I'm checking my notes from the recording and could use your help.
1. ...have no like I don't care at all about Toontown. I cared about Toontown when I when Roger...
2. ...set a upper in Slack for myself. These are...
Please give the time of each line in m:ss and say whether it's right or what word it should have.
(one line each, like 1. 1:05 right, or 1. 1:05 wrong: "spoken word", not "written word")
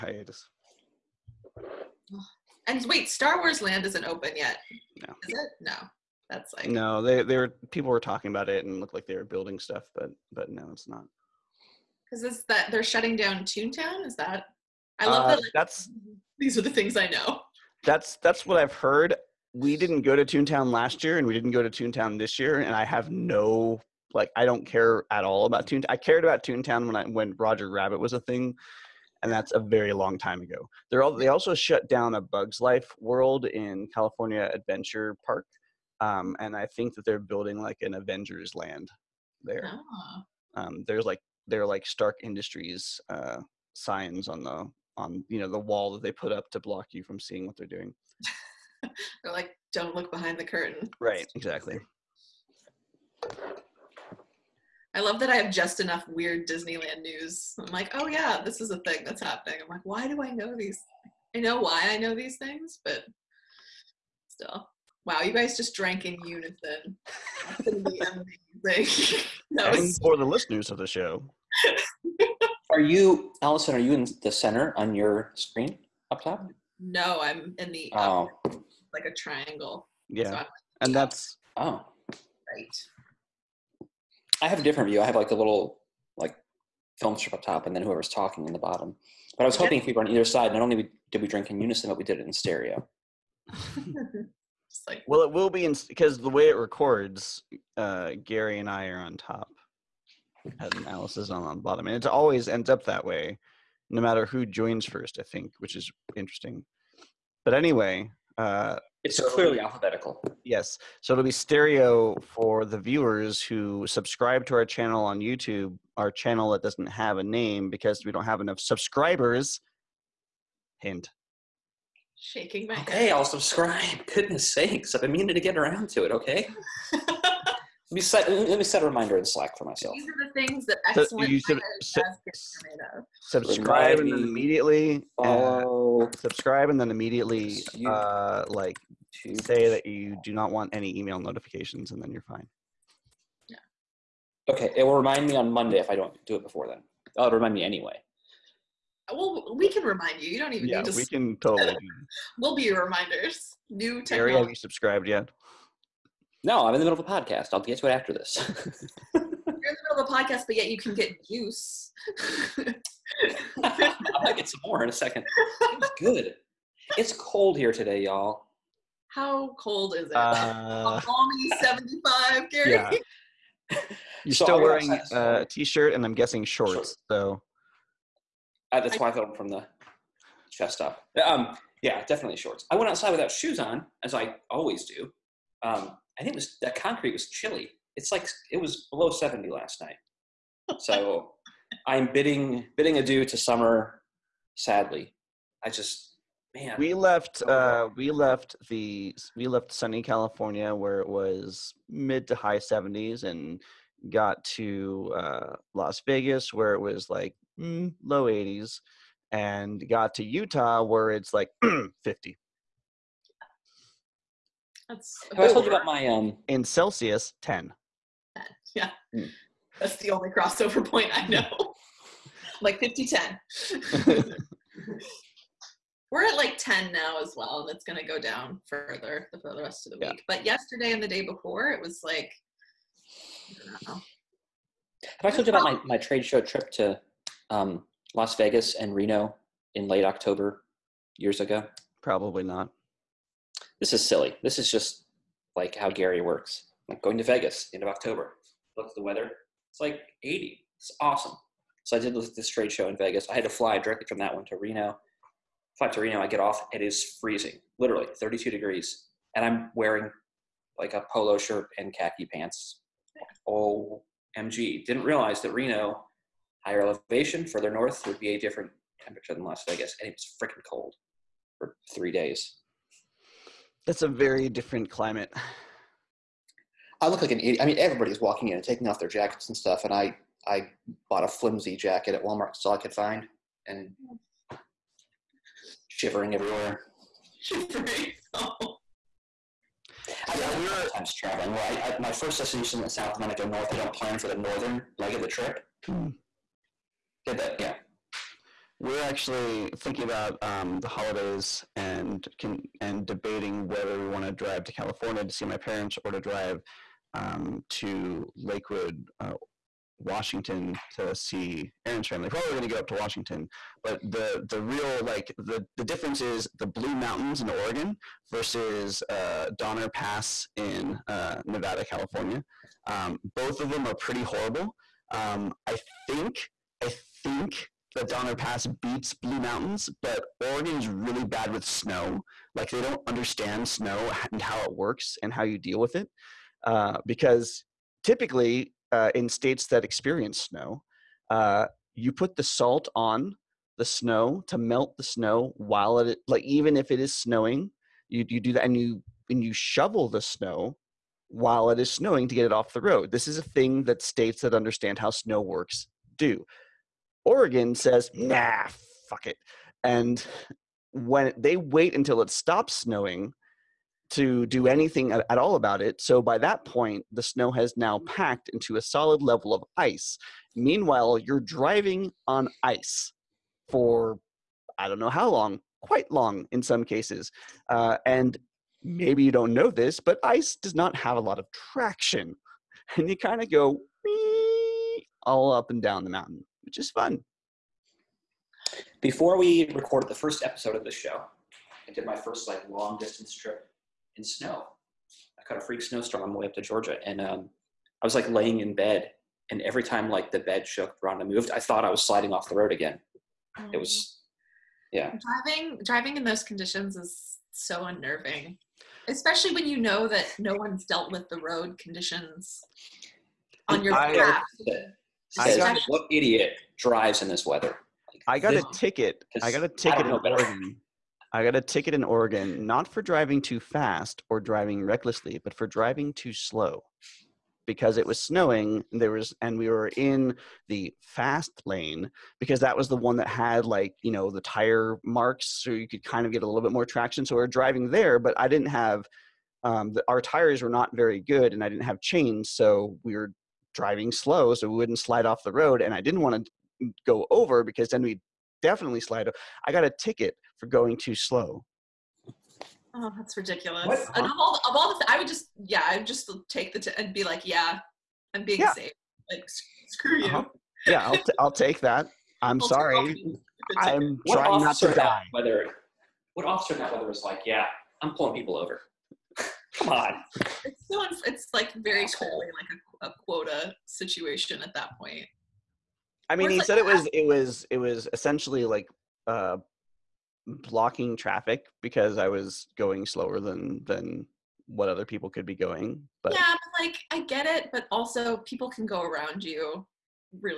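1. 0:22 right
2. 2:08 wrong: "reminder", not "upper".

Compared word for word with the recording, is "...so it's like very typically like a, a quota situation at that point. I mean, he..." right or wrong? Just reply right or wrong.
wrong.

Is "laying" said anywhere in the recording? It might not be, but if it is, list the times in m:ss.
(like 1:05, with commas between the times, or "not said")
6:38.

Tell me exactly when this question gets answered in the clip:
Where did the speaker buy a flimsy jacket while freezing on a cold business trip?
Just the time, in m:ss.
4:42.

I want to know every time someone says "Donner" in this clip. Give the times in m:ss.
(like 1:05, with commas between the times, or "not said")
5:19, 5:28.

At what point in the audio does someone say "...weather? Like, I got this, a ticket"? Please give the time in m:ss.
6:57.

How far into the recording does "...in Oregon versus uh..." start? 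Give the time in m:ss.
5:17.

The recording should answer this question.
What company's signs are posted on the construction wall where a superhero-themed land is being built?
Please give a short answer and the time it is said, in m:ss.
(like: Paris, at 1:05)
Stark Industries, at 0:41.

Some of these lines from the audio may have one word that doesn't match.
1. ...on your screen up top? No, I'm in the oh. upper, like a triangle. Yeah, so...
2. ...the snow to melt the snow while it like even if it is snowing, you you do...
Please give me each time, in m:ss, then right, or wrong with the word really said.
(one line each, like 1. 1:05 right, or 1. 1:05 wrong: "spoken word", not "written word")
1. 1:14 right
2. 5:43 right.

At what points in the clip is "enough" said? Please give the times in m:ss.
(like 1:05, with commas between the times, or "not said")
0:55, 1:58.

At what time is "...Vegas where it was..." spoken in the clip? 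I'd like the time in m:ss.
3:26.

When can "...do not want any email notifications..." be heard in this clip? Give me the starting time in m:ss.
2:20.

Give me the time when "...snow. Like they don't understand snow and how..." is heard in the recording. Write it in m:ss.
5:31.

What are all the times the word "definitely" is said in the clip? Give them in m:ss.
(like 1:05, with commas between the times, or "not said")
3:02, 7:28.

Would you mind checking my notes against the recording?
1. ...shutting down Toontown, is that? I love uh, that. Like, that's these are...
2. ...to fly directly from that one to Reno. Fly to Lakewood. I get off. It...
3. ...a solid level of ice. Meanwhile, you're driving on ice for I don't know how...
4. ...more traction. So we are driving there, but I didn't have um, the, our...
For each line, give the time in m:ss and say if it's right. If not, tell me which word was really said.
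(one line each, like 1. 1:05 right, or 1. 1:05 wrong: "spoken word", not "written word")
1. 0:12 right
2. 4:13 wrong: "Reno", not "Lakewood"
3. 6:08 right
4. 7:16 right.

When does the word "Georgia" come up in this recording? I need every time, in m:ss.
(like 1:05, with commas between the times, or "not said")
6:36.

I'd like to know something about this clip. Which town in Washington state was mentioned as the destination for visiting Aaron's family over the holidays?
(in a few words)
Lakewood.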